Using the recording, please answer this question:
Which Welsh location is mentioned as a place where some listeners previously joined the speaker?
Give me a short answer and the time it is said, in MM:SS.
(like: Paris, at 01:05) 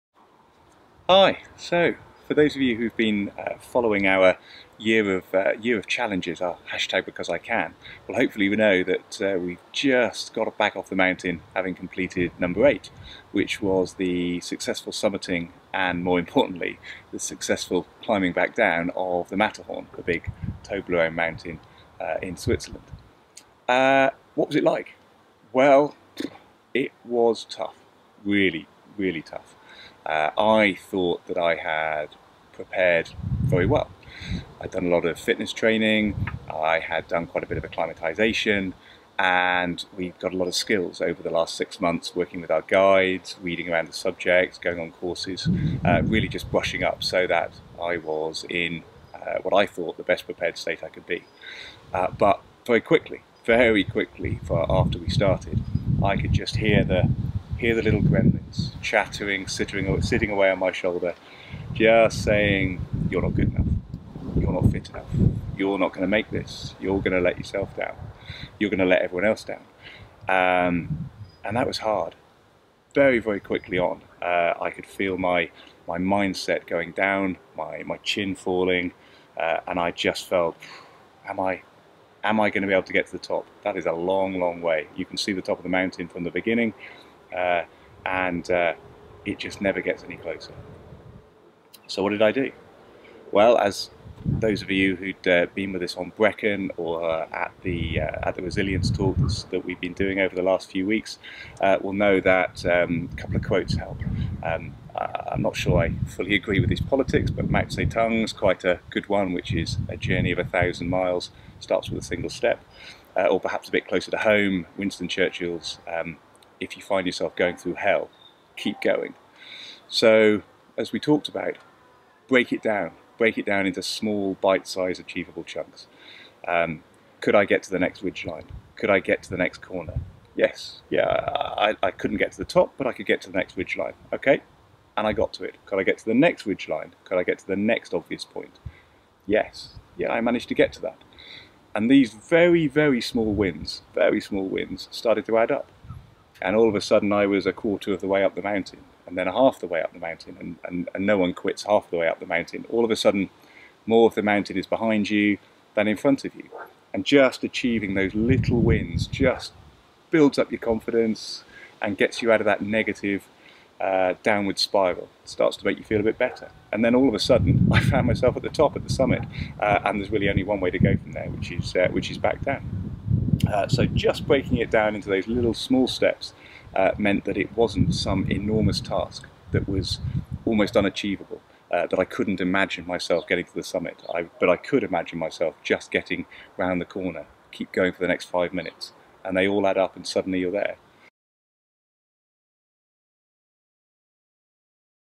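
Brecon, at 01:36.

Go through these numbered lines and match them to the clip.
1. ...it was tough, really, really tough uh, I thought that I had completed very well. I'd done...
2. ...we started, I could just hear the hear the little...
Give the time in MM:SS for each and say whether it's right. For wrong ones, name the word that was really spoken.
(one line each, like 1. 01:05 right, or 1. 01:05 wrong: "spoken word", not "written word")
1. 00:26 wrong: "prepared", not "completed"
2. 00:54 right.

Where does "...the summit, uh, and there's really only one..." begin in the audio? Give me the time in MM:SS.
02:48.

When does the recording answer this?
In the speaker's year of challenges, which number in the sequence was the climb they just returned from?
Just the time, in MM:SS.
00:12.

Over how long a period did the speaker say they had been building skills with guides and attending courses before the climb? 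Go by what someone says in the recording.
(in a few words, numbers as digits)
6 months.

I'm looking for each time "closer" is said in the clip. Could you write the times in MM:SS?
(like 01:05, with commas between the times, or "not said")
01:30, 01:53.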